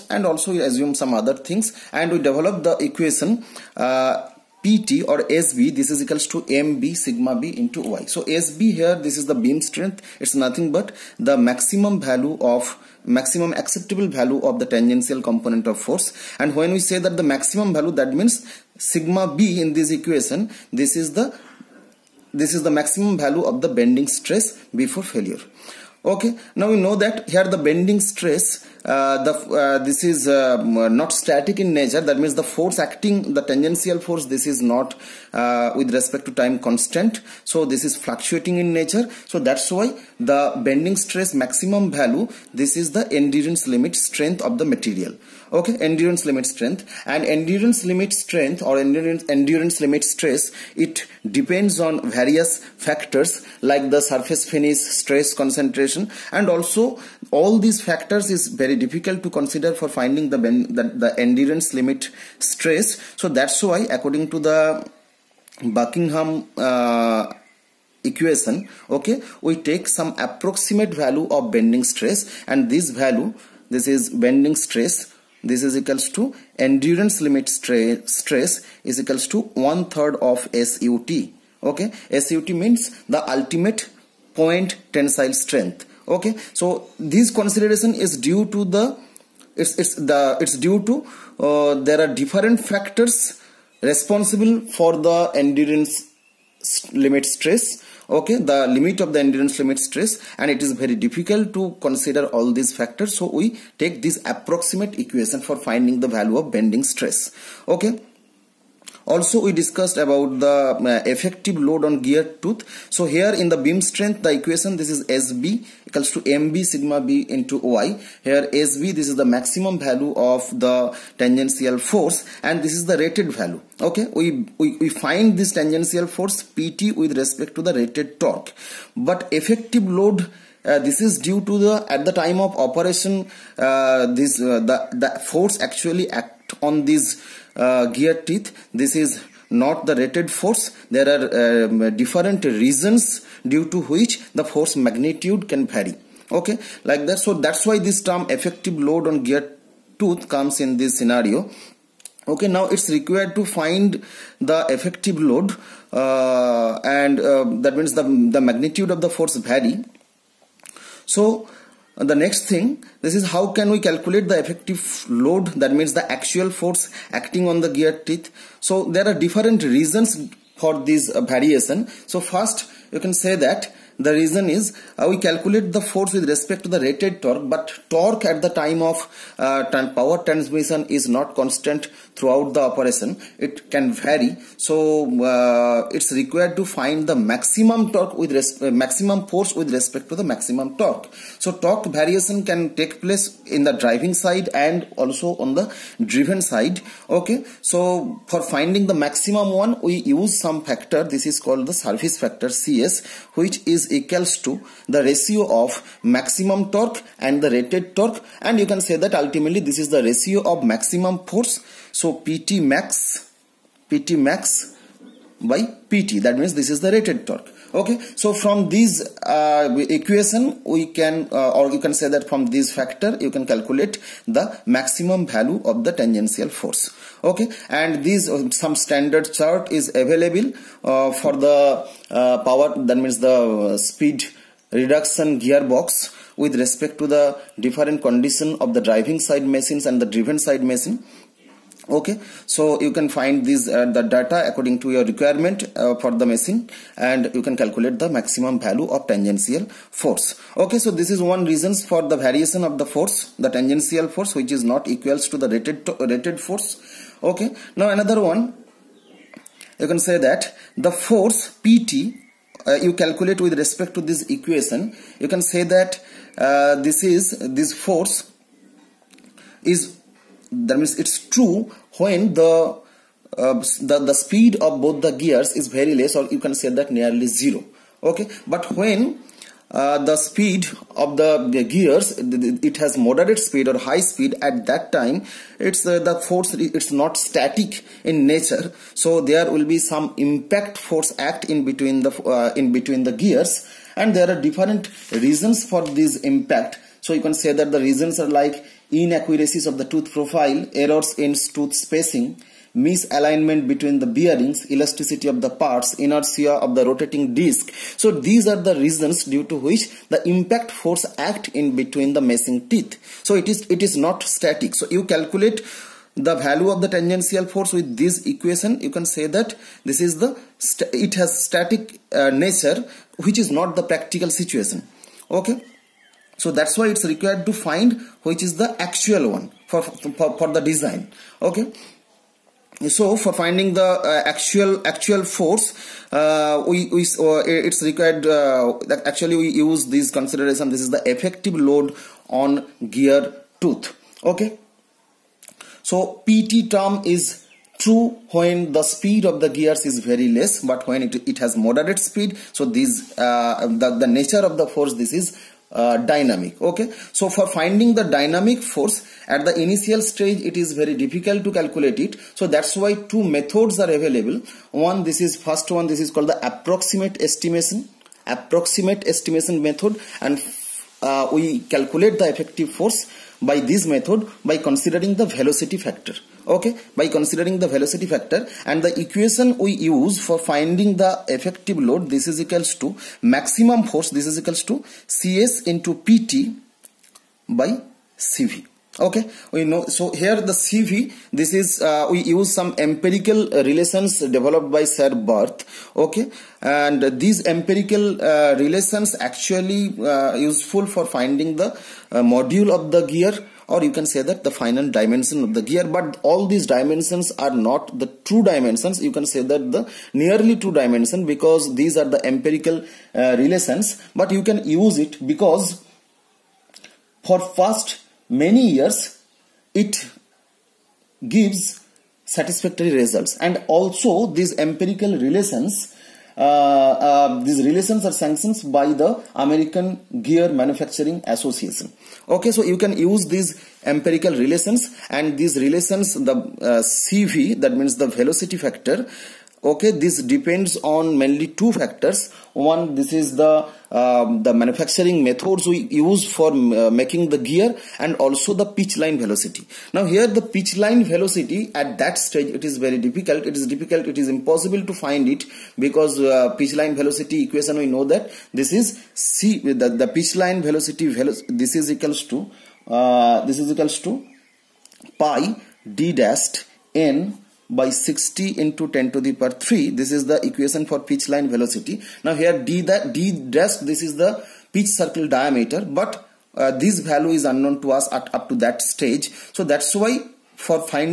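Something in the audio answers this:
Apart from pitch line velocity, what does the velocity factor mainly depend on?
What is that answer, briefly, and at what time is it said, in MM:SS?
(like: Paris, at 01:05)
manufacturing methods, at 07:24.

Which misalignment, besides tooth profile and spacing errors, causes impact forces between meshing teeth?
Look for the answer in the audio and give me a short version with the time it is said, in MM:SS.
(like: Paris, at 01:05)
misalignment between the bearings, at 05:02.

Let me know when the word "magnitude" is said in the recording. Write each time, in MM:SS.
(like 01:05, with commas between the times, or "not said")
02:24, 02:38.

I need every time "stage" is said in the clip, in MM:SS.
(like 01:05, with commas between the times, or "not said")
06:00, 07:32, 07:58.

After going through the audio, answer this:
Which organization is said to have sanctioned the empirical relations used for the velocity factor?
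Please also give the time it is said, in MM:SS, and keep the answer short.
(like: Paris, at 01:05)
American Gear Manufacturing Association, at 07:09.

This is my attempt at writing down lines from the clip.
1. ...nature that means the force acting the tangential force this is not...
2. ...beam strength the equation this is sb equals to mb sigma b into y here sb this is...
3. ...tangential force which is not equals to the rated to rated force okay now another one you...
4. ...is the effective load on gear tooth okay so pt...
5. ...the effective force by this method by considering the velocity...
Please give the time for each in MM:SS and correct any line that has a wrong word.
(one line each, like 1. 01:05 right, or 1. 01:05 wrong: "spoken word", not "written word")
1. 00:31 right
2. 01:53 right
3. 04:13 right
4. 05:40 right
5. 06:12 right.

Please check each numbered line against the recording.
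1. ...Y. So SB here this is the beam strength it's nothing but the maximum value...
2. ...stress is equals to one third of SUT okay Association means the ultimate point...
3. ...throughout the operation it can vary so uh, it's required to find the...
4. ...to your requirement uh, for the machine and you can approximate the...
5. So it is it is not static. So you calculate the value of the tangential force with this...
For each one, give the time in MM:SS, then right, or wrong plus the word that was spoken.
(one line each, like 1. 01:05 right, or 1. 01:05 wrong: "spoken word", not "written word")
1. 00:07 right
2. 01:17 wrong: "SUT", not "Association"
3. 03:02 right
4. 04:04 wrong: "calculate", not "approximate"
5. 05:13 right.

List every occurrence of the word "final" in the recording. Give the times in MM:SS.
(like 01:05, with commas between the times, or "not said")
06:44.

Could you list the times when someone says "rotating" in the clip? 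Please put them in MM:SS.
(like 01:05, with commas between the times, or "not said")
05:06.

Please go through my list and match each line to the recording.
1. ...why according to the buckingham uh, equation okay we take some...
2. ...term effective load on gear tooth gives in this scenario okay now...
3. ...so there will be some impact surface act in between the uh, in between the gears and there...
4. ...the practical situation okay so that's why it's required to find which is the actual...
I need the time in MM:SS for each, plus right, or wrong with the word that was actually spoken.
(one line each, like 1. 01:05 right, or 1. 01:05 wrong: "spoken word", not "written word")
1. 01:03 right
2. 02:28 wrong: "comes", not "gives"
3. 04:48 wrong: "force", not "surface"
4. 05:23 right.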